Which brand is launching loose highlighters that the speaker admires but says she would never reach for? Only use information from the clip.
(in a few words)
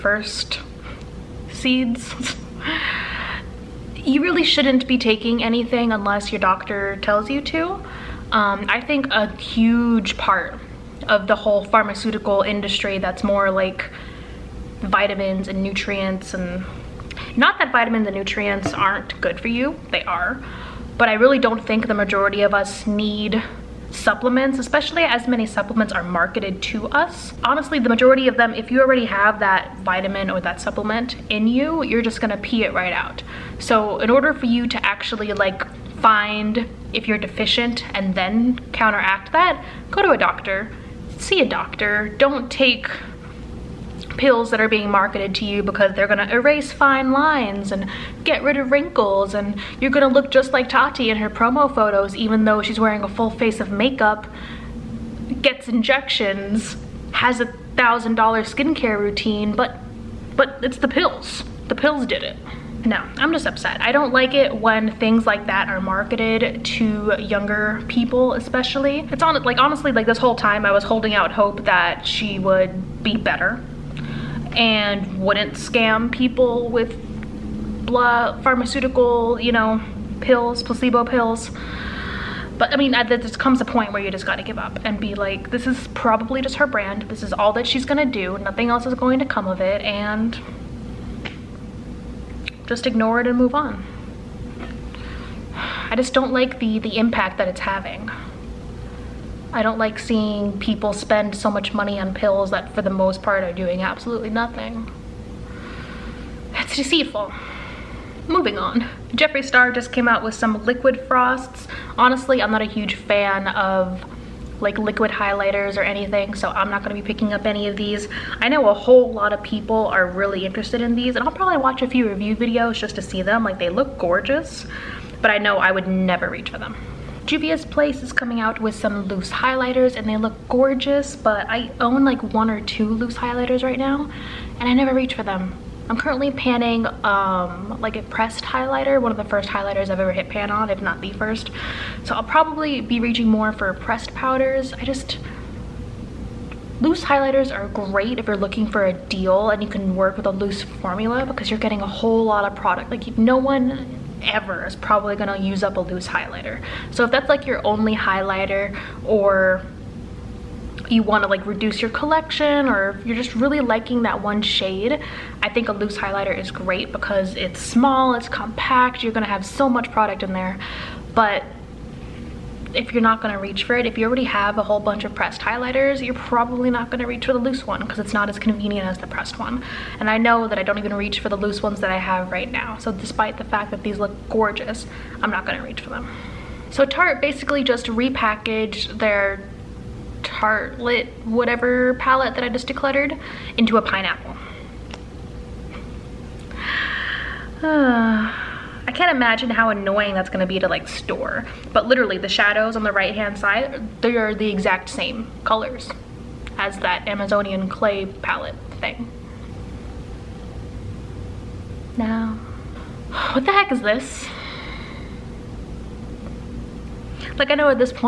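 Juvia's Place.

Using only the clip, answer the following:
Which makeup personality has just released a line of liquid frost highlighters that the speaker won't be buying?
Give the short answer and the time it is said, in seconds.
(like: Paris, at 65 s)
Jeffree Star, at 109 s.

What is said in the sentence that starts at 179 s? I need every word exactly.
And I know that I don't even reach for the loose ones that I have right now.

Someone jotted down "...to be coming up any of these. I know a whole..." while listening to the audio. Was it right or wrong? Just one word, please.
wrong.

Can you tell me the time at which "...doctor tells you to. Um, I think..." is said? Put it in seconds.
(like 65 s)
6 s.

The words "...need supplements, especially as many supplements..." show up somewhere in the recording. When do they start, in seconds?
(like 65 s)
22 s.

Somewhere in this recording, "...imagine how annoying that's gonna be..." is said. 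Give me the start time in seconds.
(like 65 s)
199 s.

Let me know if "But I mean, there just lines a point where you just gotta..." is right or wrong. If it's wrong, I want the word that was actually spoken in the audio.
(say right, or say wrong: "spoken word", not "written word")
wrong: "comes", not "lines".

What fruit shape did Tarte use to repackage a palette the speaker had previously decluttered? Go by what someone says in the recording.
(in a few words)
Pineapple.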